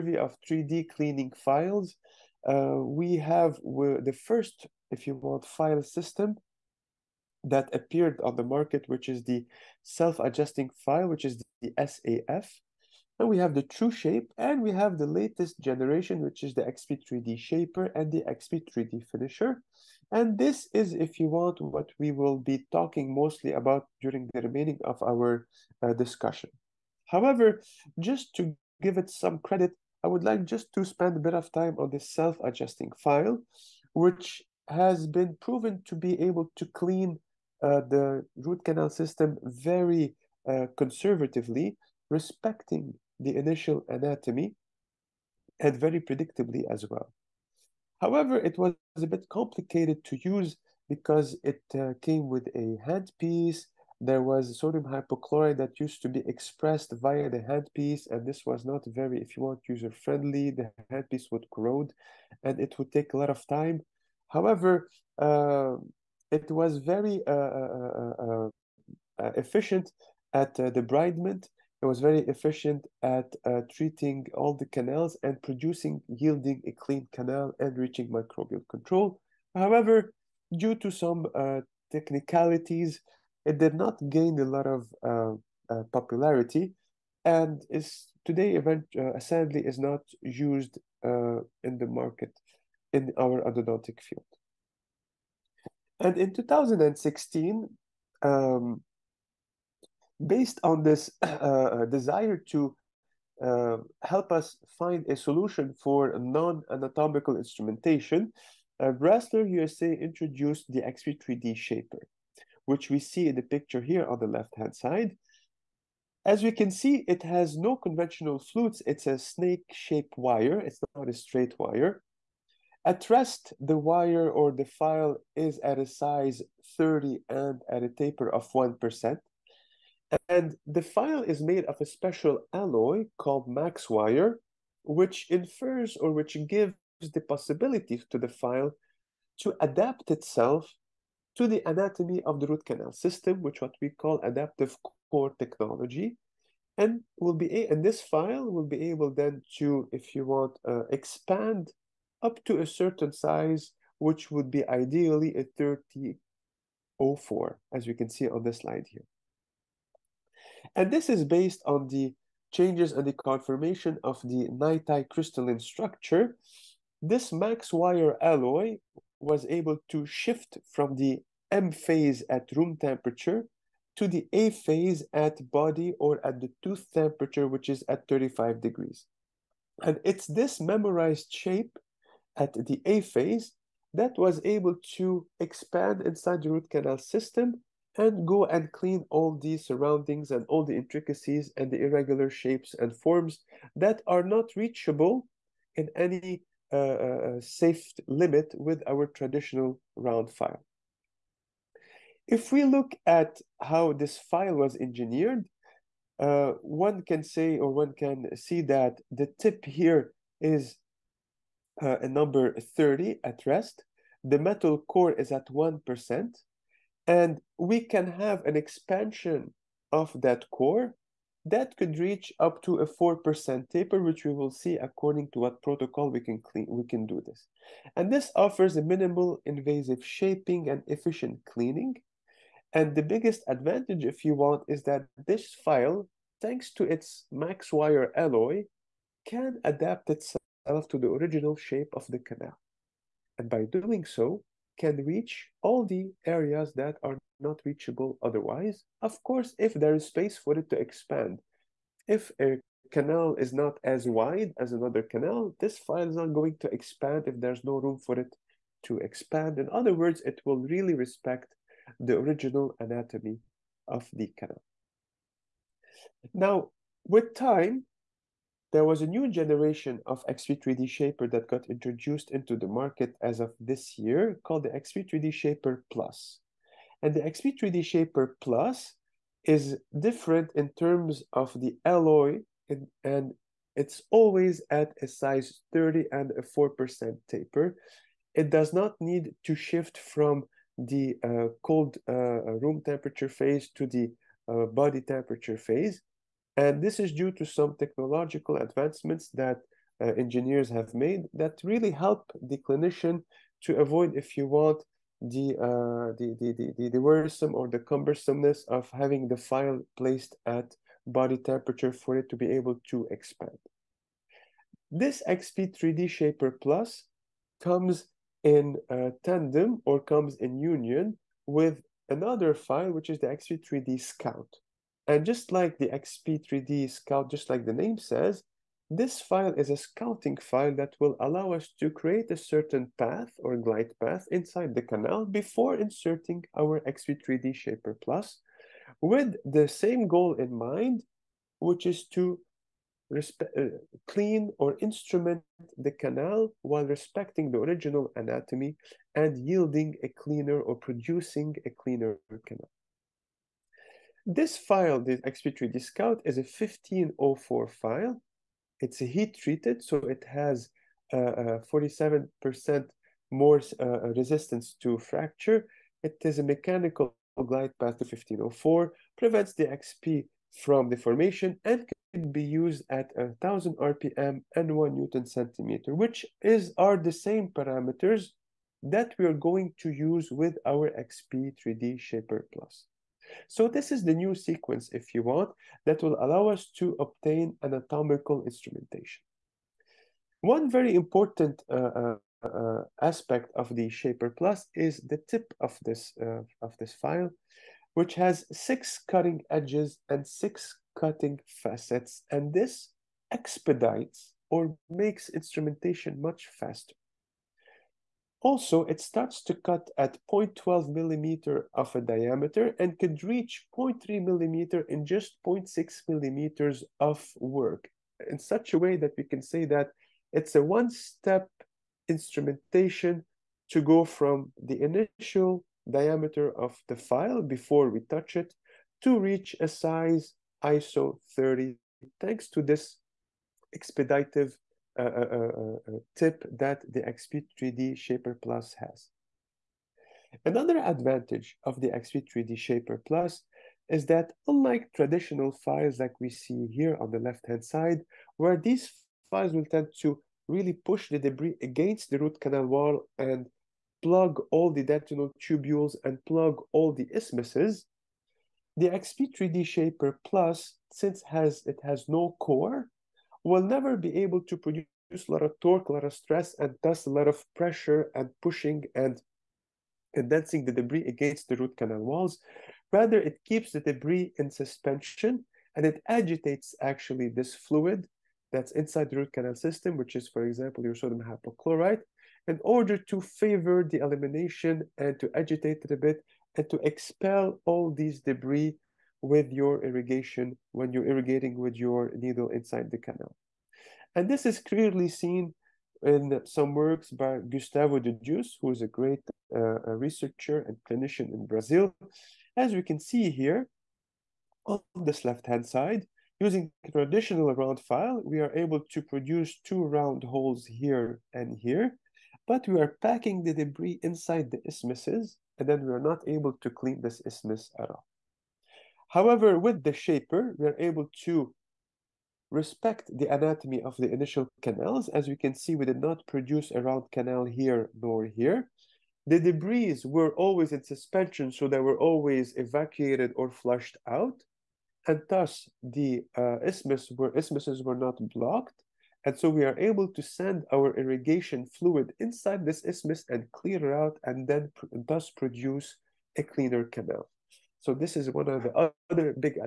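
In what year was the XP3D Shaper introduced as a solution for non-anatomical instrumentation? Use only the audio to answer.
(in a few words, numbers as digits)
2016.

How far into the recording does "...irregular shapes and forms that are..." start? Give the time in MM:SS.
03:11.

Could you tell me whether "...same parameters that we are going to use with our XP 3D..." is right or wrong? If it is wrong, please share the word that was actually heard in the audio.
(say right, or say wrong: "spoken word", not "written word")
right.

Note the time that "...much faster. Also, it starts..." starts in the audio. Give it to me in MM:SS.
06:46.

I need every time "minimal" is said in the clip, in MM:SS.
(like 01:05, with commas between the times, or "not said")
03:48.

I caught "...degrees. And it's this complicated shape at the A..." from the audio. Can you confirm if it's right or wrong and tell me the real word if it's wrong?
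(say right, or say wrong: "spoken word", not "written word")
wrong: "memorized", not "complicated".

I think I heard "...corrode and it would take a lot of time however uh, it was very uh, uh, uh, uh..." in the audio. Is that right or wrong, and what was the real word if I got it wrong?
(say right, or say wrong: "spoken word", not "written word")
right.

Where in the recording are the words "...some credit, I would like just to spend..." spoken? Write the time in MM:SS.
00:29.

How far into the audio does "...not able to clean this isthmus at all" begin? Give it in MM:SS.
08:36.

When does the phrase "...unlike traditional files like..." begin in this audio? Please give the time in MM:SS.
07:24.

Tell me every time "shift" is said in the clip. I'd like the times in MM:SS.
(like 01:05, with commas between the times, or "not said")
02:50, 04:49.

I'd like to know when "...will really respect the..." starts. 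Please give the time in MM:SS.
04:20.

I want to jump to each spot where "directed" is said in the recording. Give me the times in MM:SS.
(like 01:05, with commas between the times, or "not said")
not said.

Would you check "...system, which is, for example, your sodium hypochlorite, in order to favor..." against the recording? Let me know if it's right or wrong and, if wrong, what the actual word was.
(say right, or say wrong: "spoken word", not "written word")
right.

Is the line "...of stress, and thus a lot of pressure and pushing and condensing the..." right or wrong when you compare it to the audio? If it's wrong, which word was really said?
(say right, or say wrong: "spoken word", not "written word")
right.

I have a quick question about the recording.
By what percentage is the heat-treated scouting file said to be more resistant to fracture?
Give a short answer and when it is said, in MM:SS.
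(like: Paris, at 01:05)
47%, at 06:01.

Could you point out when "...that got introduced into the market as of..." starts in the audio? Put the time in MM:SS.
04:31.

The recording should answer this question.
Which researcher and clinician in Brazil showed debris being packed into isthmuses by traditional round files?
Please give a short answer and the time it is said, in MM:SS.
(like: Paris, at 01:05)
Gustavo de Deus, at 08:17.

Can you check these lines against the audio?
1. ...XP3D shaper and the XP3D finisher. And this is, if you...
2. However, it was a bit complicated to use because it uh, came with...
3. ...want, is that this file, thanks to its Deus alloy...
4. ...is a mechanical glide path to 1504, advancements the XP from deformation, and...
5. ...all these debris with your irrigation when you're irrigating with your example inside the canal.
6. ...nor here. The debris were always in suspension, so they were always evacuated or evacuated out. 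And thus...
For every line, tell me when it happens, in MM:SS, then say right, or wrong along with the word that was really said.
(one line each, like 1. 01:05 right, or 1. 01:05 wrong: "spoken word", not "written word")
1. 00:16 right
2. 00:48 right
3. 03:54 wrong: "MaxWire", not "Deus"
4. 06:06 wrong: "prevents", not "advancements"
5. 08:07 wrong: "needle", not "example"
6. 08:48 wrong: "flushed", not "evacuated".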